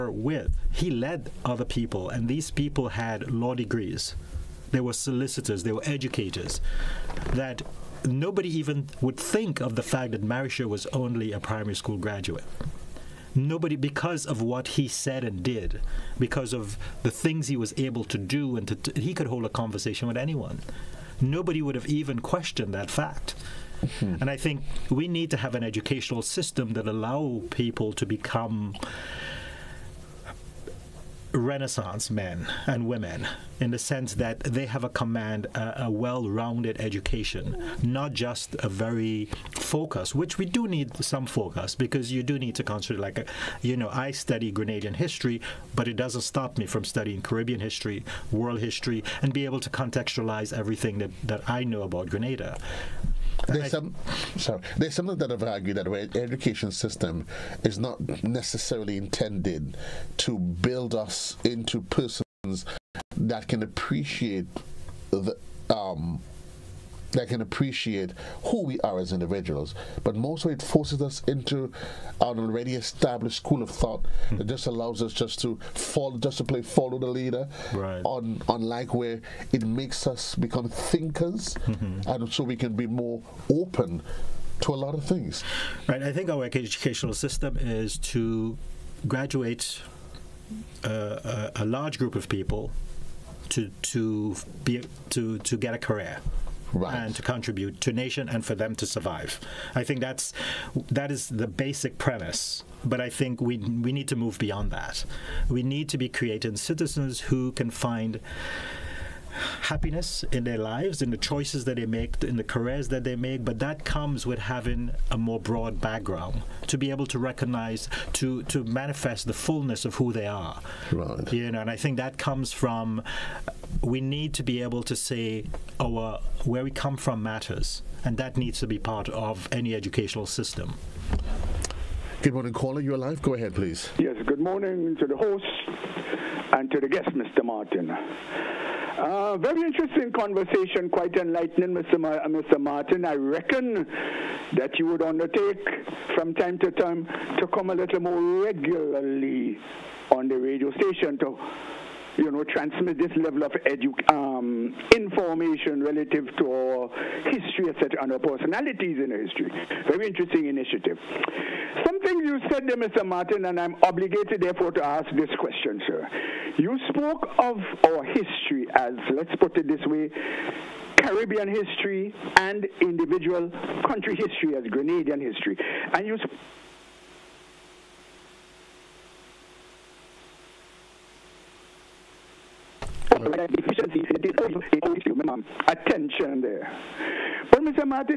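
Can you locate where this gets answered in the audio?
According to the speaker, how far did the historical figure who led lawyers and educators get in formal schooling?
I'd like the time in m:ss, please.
0:11.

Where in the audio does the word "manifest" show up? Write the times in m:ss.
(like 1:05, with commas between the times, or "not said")
1:58.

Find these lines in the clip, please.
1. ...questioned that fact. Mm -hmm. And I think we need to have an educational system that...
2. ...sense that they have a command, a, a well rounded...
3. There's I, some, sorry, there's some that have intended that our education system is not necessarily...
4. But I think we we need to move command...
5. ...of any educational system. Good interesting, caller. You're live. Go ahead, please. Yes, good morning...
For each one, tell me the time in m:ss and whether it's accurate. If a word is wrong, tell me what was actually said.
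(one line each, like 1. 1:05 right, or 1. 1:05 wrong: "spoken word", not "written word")
1. 0:22 right
2. 0:33 right
3. 0:53 wrong: "argued", not "intended"
4. 1:42 wrong: "beyond", not "command"
5. 2:09 wrong: "morning", not "interesting".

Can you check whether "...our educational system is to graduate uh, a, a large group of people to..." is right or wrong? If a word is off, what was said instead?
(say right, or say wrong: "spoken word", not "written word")
right.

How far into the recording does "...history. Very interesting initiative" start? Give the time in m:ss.
2:39.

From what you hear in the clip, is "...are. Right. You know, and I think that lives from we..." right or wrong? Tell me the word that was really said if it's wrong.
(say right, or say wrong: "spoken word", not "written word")
wrong: "comes", not "lives".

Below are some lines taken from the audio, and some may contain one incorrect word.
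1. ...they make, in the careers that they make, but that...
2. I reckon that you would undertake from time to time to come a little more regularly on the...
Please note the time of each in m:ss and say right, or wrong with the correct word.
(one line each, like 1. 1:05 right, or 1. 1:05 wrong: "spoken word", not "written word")
1. 1:51 right
2. 2:23 right.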